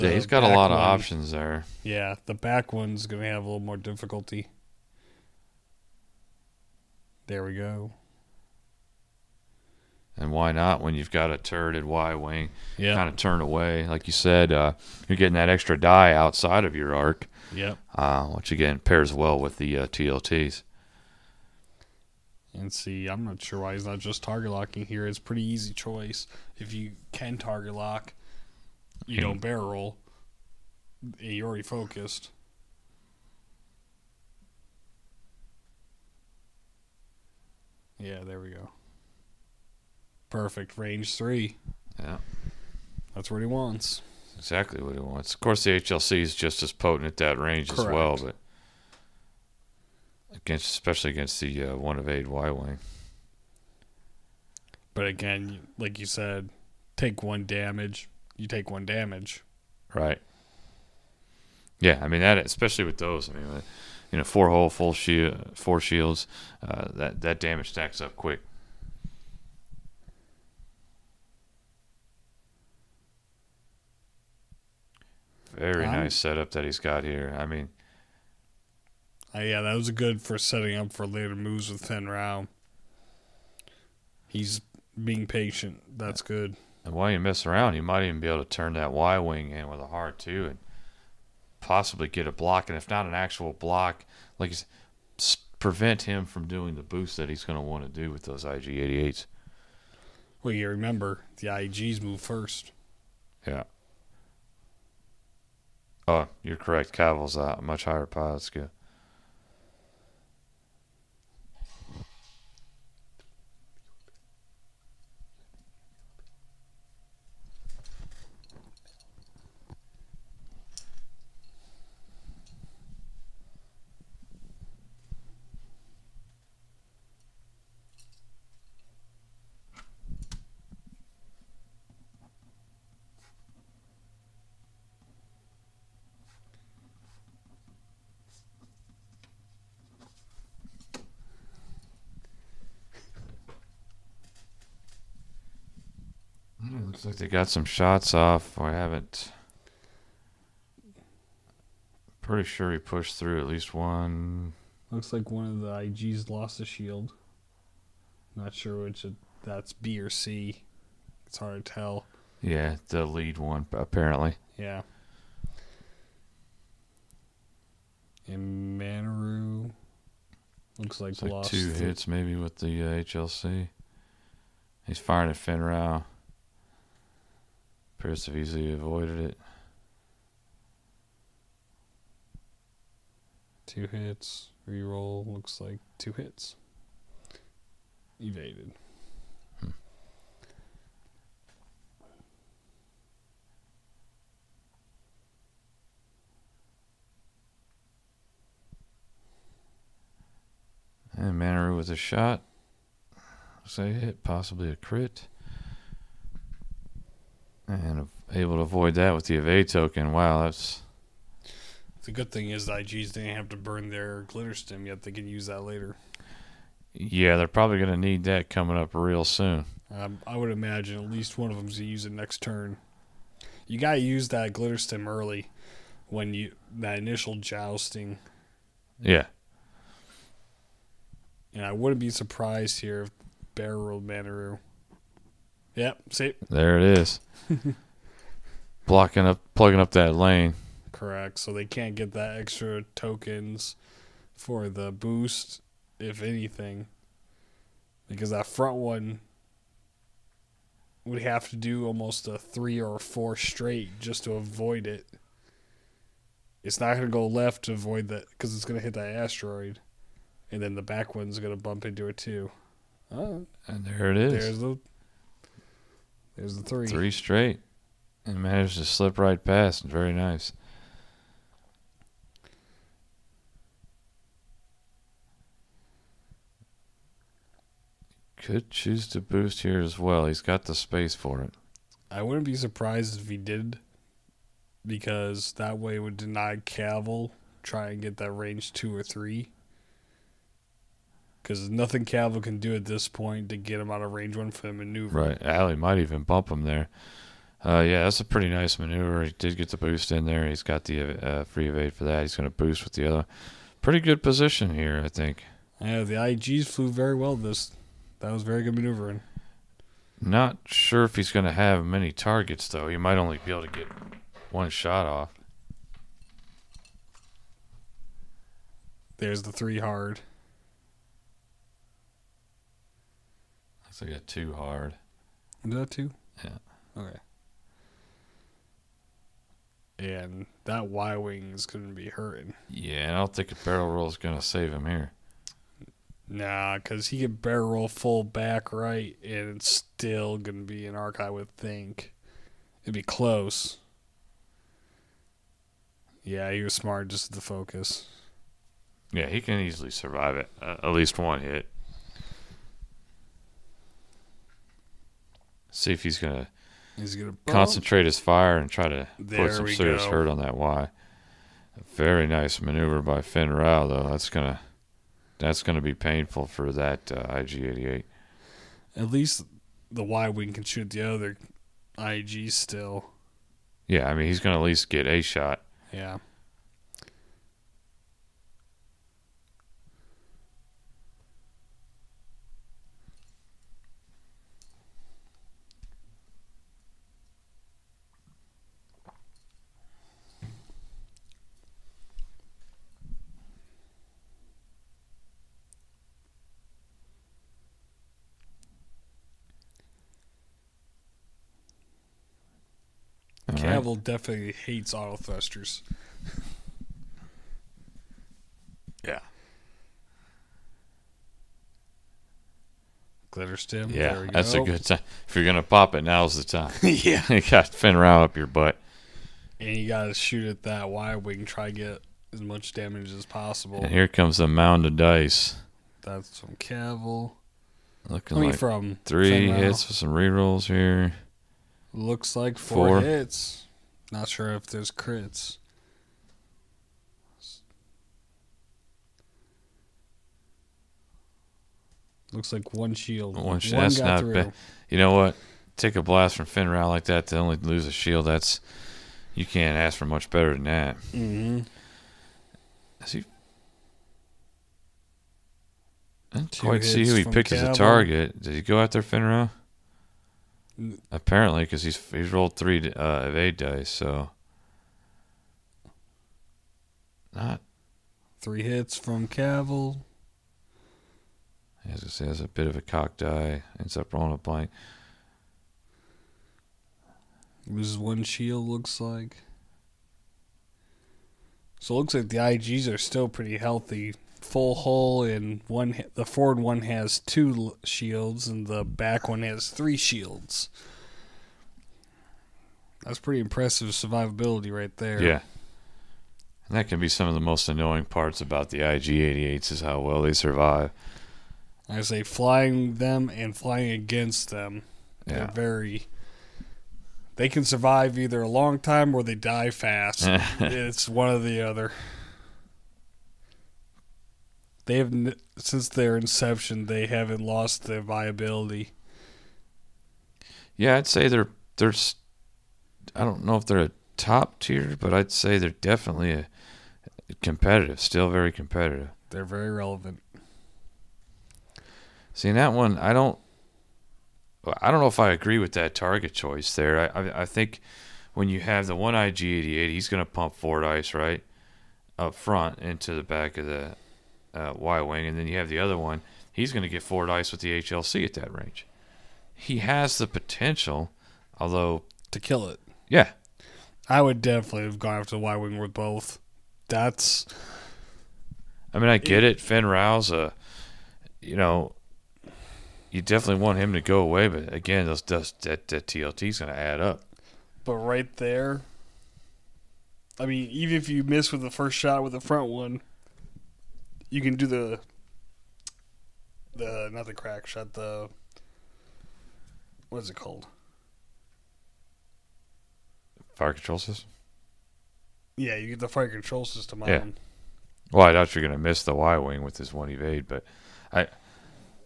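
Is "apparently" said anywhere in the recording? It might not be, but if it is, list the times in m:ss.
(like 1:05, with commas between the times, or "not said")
2:43, 7:41.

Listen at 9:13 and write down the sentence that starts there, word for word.
Yeah, I would definitely have gone after the Y wing with both.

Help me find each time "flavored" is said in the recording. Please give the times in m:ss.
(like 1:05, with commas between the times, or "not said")
not said.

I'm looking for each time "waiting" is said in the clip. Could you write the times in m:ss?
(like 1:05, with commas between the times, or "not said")
not said.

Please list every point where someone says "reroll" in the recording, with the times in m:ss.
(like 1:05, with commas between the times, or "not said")
3:04, 7:10.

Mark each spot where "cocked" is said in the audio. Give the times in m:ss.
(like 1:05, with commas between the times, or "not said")
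7:52.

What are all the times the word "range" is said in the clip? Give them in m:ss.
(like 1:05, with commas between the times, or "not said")
0:40, 0:47, 4:48, 4:54, 9:08.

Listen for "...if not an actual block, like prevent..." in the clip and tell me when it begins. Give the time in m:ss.
1:32.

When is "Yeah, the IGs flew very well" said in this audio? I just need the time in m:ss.
5:05.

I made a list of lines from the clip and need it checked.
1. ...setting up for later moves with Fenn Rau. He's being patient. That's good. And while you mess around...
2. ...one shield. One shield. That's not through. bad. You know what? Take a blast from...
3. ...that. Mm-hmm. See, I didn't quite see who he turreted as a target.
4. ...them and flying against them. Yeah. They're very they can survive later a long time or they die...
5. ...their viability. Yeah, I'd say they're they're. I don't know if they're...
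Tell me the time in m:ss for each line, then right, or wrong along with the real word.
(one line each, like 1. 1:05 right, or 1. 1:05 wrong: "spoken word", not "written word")
1. 1:20 right
2. 7:22 right
3. 7:30 wrong: "picked", not "turreted"
4. 8:22 wrong: "either", not "later"
5. 8:37 right.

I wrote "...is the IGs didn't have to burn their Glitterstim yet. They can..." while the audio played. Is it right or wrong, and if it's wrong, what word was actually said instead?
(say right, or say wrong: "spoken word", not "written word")
right.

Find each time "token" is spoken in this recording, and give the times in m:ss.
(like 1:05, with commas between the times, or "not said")
3:29, 4:02.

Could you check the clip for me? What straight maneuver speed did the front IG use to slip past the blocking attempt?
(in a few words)
3.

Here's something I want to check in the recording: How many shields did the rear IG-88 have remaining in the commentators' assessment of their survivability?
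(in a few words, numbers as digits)
3.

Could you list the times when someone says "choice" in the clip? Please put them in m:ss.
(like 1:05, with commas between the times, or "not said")
0:25, 8:56.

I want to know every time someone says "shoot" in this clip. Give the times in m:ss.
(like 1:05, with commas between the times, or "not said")
6:10, 7:00.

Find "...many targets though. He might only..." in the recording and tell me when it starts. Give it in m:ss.
5:11.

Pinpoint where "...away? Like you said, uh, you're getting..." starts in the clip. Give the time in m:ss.
0:13.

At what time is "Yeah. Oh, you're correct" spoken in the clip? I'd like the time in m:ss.
1:43.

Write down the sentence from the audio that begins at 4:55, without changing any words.
Right, Ali might even bump him there.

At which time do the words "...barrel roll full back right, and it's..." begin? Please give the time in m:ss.
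5:37.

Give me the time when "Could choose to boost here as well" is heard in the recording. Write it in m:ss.
4:38.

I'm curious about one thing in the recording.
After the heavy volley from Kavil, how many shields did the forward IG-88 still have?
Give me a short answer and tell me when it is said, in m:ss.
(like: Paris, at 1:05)
2, at 8:07.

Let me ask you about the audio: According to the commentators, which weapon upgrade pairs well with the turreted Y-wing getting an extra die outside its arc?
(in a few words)
TLTs.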